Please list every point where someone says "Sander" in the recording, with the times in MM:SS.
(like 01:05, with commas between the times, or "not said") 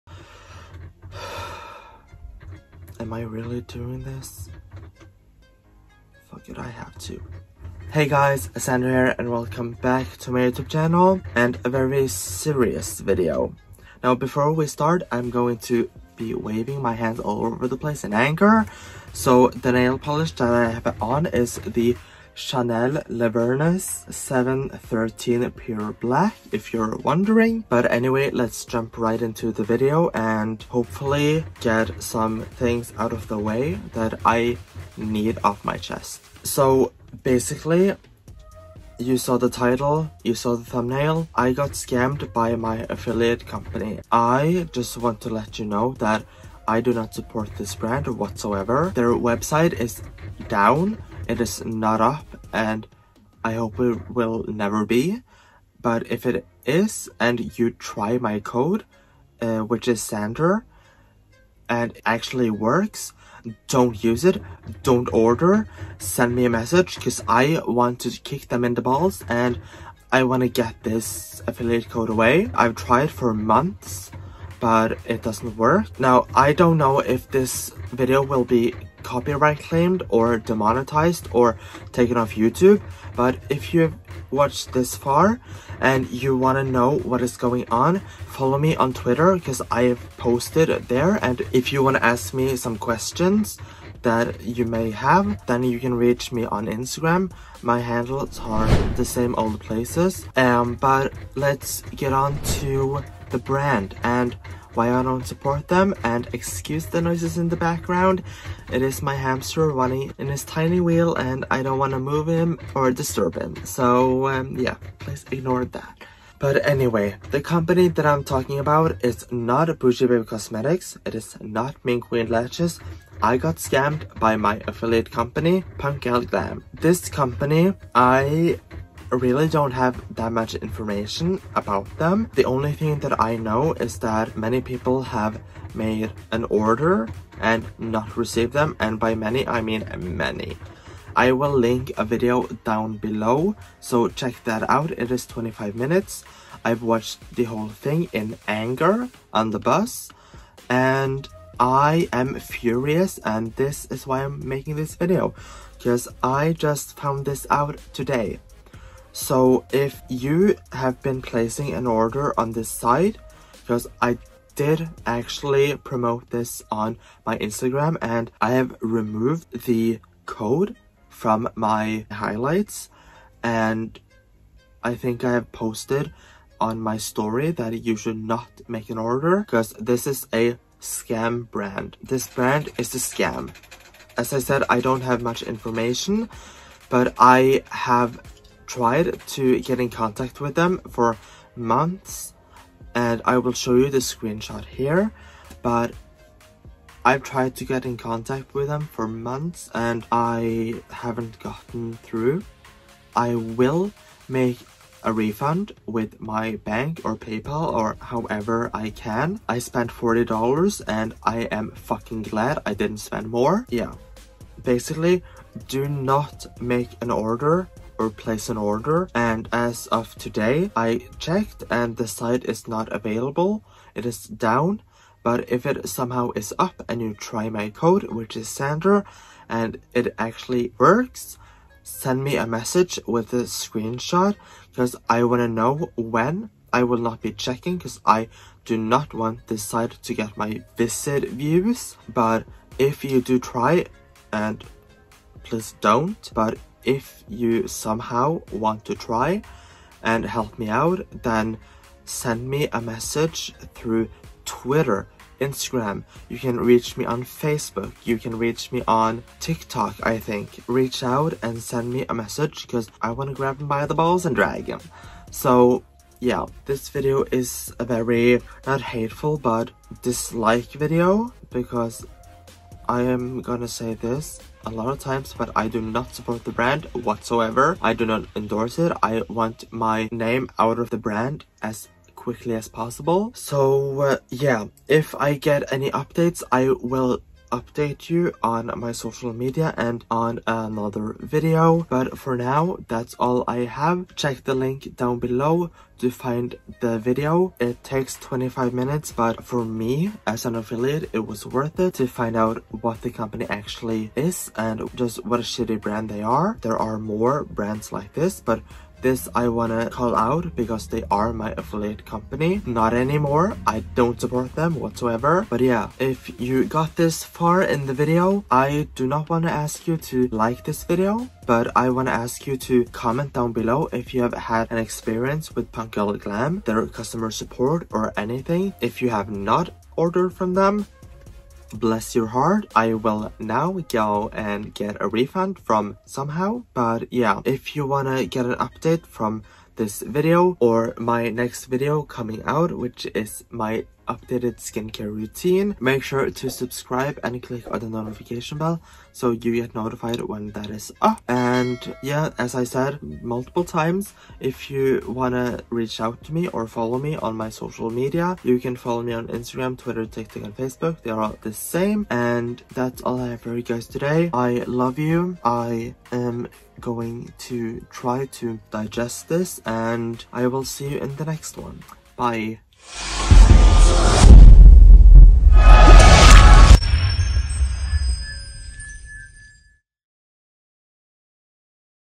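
00:08, 01:00, 03:48.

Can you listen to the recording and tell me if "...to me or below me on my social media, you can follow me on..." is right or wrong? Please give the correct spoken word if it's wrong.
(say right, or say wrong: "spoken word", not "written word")
wrong: "follow", not "below".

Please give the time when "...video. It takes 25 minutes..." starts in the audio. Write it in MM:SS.
04:56.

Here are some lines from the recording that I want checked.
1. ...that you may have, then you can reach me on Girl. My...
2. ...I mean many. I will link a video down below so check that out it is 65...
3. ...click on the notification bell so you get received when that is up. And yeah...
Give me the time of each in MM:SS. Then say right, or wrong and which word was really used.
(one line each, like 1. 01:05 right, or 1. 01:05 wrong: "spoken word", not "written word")
1. 01:34 wrong: "Instagram", not "Girl"
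2. 02:19 wrong: "25", not "65"
3. 05:47 wrong: "notified", not "received".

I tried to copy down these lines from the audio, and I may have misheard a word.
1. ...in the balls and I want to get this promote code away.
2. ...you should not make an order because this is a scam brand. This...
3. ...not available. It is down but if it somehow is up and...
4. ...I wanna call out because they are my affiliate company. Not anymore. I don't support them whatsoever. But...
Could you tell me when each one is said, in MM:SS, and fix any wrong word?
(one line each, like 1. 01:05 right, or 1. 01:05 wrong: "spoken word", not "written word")
1. 01:08 wrong: "affiliate", not "promote"
2. 02:57 right
3. 03:42 right
4. 05:09 right.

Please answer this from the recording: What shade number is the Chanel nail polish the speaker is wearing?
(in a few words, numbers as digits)
713.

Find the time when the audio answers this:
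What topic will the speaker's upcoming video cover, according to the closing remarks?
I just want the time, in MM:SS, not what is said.
05:44.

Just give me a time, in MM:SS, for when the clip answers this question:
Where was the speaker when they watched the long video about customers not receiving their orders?
02:29.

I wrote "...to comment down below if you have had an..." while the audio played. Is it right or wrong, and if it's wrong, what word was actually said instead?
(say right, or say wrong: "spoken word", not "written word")
right.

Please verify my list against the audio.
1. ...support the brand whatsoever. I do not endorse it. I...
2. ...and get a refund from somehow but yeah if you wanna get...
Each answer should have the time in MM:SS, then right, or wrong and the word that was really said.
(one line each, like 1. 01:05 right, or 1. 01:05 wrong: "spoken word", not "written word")
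1. 04:36 right
2. 05:34 right.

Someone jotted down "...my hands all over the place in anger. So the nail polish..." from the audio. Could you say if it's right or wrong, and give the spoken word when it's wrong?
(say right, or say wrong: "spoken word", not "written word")
right.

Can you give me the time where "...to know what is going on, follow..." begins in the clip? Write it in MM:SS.
01:26.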